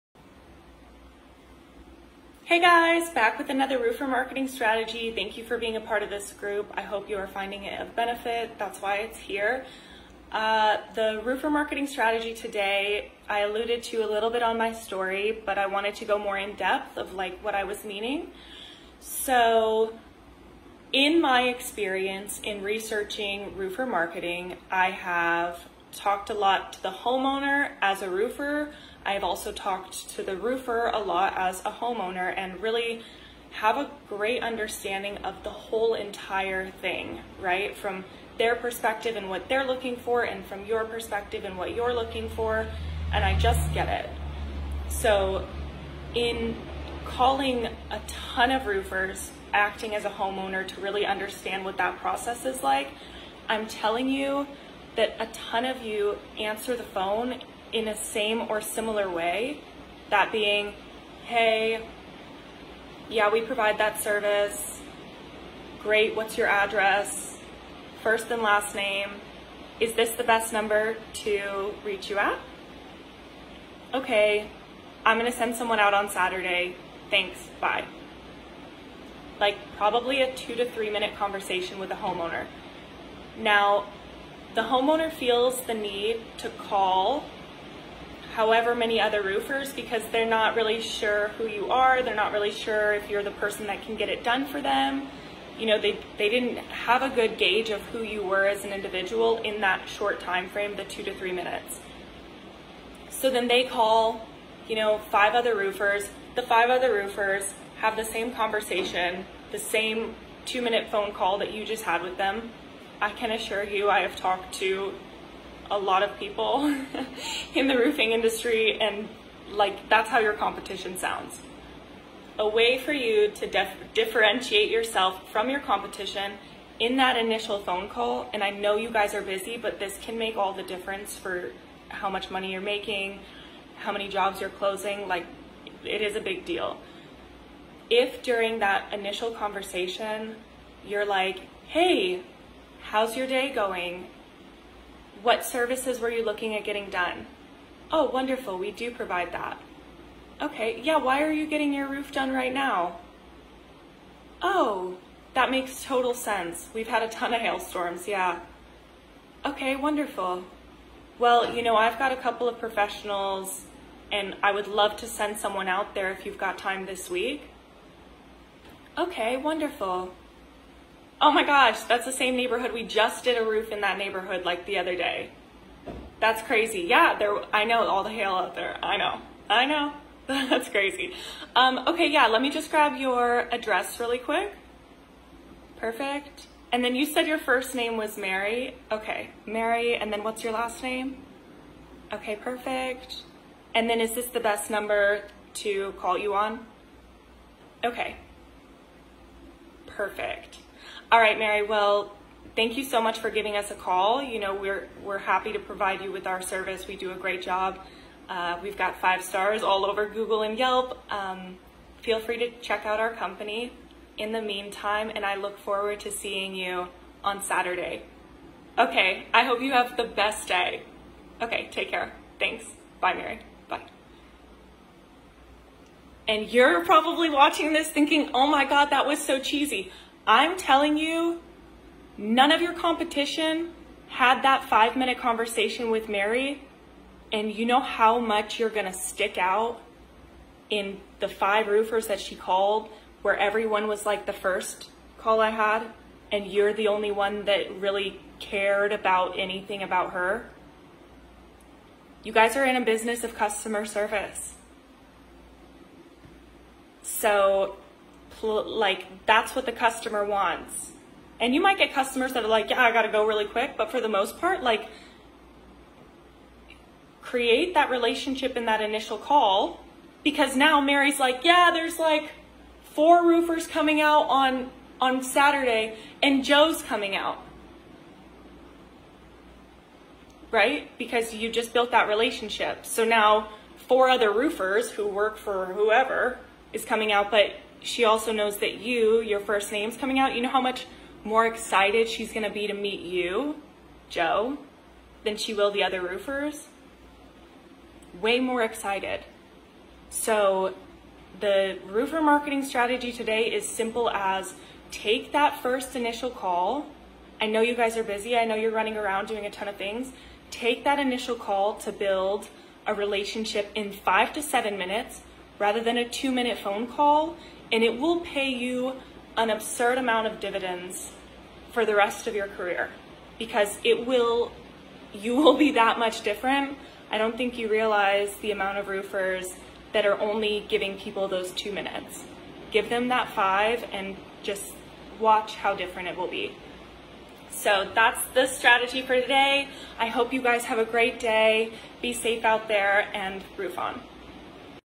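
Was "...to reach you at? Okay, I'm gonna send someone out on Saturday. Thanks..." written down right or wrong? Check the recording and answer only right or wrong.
right.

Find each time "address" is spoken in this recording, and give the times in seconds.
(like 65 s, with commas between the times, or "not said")
66 s, 183 s.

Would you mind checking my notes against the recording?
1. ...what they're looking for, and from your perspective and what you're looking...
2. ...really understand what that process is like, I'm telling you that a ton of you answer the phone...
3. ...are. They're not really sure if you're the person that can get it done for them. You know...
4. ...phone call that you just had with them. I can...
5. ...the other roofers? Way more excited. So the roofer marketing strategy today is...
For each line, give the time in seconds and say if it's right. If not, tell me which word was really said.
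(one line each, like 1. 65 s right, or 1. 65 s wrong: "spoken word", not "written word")
1. 39 s right
2. 50 s right
3. 91 s right
4. 110 s right
5. 295 s right.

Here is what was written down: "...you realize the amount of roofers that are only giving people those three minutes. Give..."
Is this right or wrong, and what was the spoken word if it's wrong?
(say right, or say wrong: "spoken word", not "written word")
wrong: "two", not "three".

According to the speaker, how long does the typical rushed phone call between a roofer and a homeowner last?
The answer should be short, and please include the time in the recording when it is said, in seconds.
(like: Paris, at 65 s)
2 to 3 minutes, at 80 s.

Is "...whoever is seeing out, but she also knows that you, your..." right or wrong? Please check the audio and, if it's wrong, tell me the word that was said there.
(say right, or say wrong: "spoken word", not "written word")
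wrong: "coming", not "seeing".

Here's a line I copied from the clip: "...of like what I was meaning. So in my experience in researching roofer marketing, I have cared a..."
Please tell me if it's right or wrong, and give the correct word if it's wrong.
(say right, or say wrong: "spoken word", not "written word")
wrong: "talked", not "cared".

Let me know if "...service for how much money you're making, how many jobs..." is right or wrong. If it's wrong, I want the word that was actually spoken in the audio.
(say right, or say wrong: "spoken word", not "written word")
wrong: "difference", not "service".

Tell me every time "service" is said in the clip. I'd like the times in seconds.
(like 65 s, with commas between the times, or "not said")
64 s, 145 s, 206 s, 253 s.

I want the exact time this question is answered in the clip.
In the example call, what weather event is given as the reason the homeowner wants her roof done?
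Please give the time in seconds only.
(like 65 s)
157 s.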